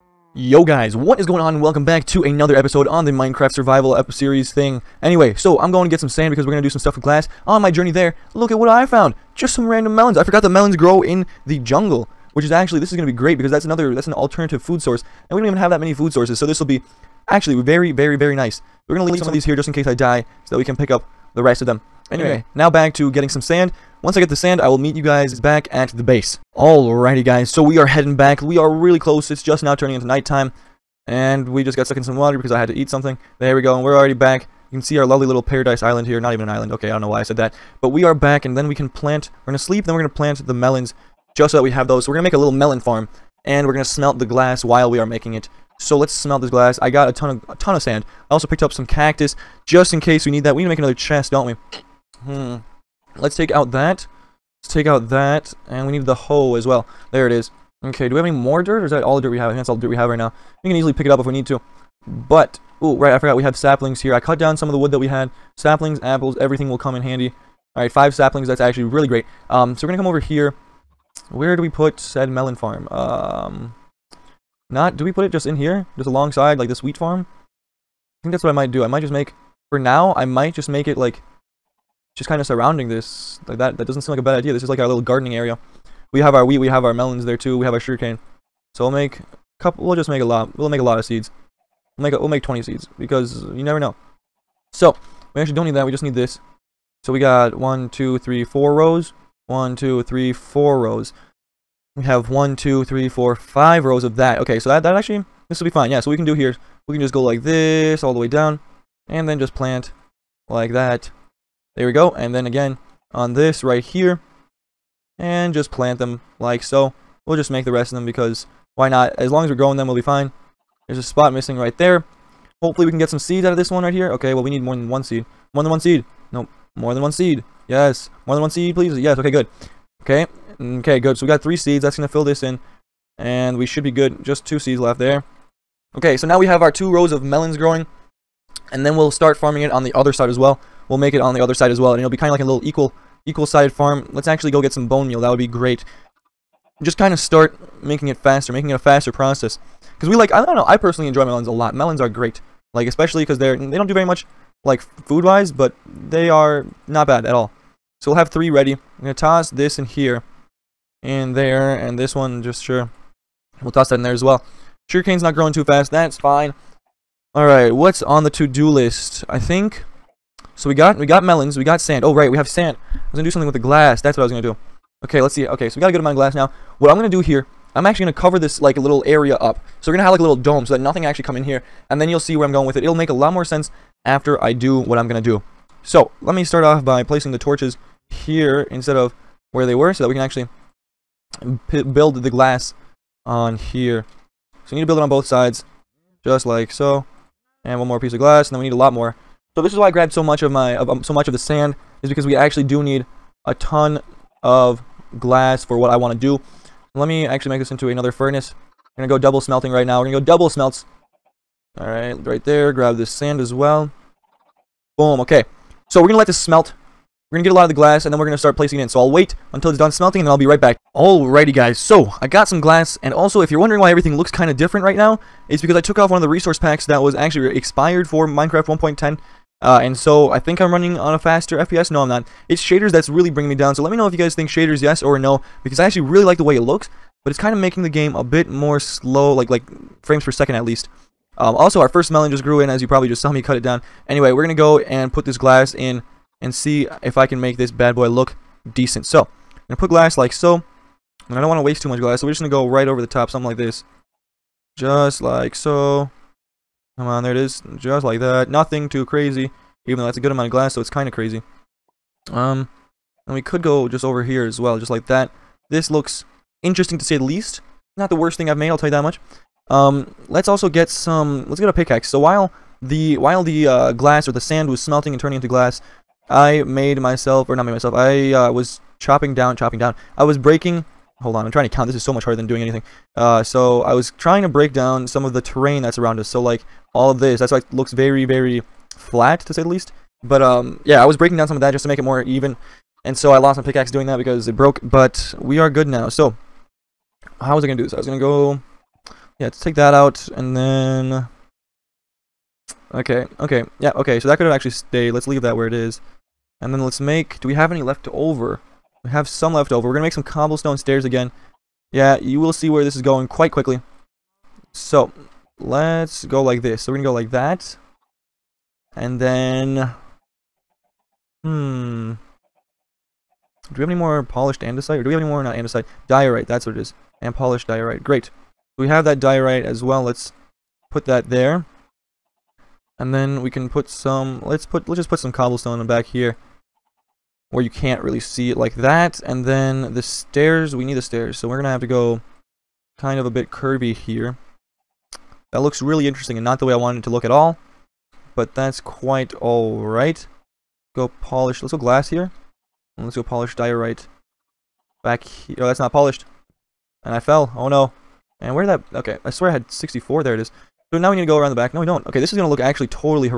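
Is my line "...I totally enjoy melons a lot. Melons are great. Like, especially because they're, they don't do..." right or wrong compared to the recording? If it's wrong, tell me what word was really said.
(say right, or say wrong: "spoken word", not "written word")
wrong: "personally", not "totally".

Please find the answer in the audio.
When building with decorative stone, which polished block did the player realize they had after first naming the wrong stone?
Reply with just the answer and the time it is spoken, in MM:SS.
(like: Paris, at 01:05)
Polished diorite, at 05:27.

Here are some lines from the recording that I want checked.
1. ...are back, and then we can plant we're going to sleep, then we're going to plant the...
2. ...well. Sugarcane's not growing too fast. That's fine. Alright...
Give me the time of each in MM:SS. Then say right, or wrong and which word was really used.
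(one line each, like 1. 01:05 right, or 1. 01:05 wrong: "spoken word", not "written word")
1. 00:38 right
2. 02:44 right.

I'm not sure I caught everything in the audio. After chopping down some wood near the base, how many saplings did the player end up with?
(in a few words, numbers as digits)
5.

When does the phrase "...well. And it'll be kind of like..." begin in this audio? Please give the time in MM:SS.
02:21.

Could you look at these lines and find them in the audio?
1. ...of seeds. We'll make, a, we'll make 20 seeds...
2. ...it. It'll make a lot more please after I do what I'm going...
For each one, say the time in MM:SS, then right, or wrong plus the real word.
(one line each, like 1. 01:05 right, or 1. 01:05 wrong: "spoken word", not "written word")
1. 01:30 right
2. 03:02 wrong: "sense", not "please".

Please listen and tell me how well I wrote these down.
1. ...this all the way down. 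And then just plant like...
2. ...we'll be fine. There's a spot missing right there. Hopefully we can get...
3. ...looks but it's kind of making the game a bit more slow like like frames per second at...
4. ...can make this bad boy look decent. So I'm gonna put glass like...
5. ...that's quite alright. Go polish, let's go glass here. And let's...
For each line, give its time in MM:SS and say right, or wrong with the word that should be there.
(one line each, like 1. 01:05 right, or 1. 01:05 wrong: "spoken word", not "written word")
1. 01:47 right
2. 01:59 right
3. 03:56 right
4. 04:07 right
5. 05:48 right.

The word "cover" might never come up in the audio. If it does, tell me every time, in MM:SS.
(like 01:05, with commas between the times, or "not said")
02:58.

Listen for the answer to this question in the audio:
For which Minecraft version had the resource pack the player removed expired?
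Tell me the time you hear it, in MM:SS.
03:48.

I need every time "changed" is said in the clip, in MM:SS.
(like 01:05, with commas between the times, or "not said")
not said.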